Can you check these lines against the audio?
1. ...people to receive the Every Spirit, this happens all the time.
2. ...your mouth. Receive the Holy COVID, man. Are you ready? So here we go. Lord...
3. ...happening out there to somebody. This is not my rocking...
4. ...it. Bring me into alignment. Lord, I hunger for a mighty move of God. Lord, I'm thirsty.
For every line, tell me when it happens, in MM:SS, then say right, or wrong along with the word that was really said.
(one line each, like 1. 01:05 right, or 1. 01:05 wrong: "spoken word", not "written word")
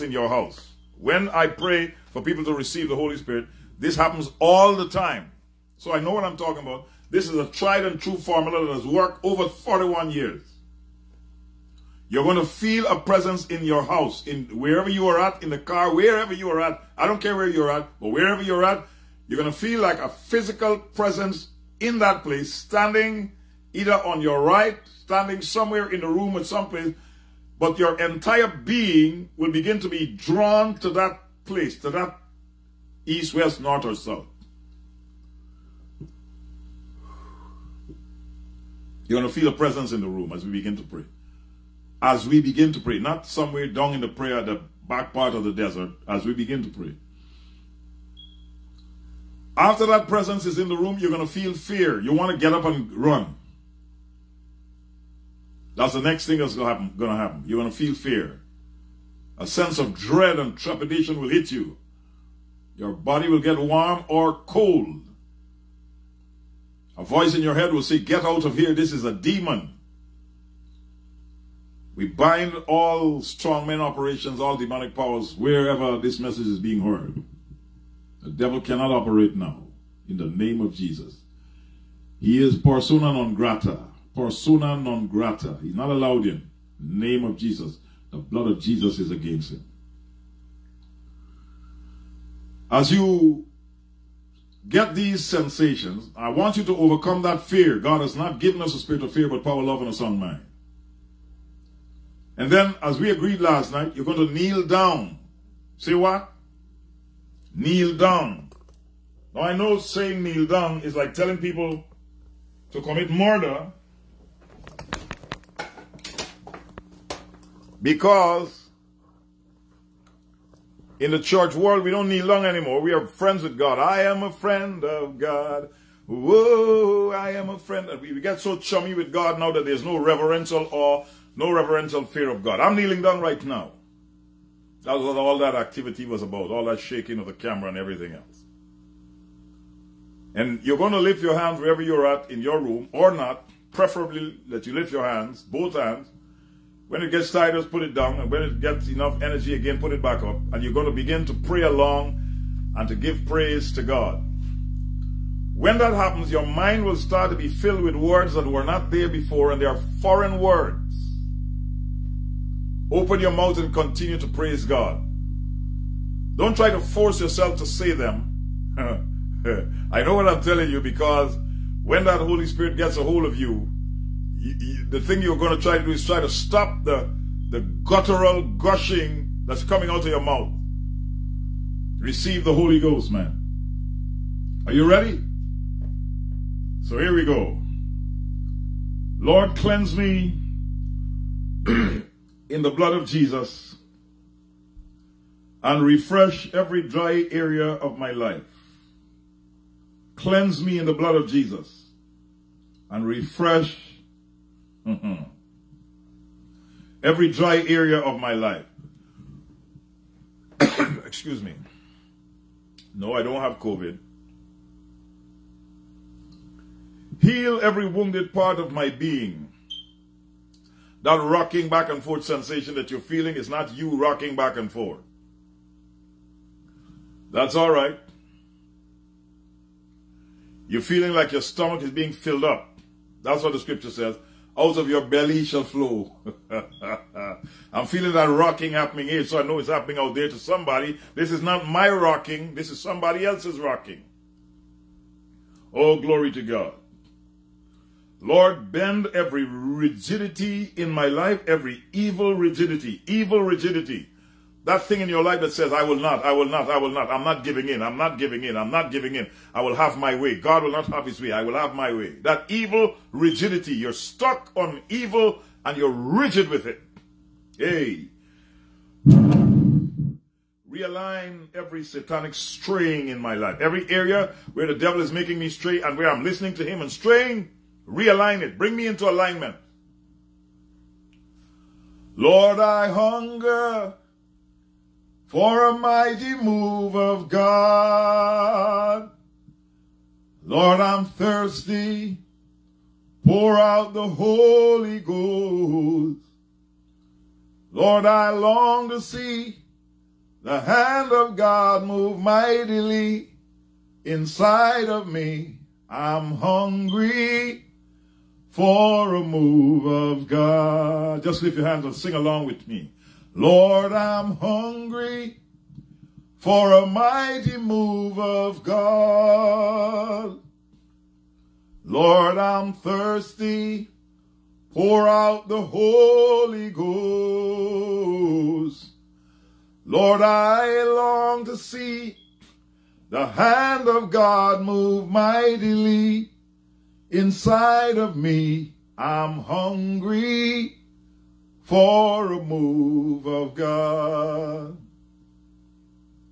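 1. 00:02 wrong: "Holy", not "Every"
2. 03:00 wrong: "Ghost", not "COVID"
3. 03:59 right
4. 04:38 right.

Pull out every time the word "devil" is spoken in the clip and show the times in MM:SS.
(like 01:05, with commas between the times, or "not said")
01:18, 04:34.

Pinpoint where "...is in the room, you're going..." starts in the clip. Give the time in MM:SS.
00:50.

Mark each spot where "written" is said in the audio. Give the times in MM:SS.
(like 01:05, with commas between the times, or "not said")
not said.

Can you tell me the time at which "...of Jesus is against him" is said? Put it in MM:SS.
01:28.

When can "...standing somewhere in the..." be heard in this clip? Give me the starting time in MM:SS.
00:24.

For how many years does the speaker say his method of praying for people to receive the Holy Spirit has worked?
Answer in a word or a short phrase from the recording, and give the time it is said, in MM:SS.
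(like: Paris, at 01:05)
41, at 00:09.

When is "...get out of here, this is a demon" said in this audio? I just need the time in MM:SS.
01:07.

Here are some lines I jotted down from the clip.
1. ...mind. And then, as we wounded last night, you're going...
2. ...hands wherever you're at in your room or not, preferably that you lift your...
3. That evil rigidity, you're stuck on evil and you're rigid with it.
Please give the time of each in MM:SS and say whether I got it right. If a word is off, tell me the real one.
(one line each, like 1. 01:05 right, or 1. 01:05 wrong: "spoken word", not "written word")
1. 01:40 wrong: "agreed", not "wounded"
2. 02:21 right
3. 04:22 right.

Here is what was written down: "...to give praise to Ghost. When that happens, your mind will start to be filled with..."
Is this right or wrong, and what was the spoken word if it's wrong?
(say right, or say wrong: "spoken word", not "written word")
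wrong: "God", not "Ghost".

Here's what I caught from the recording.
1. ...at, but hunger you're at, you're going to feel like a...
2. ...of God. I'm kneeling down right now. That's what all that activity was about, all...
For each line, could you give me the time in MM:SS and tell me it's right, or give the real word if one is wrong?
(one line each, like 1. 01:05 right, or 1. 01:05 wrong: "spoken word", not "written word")
1. 00:17 wrong: "wherever", not "hunger"
2. 02:12 right.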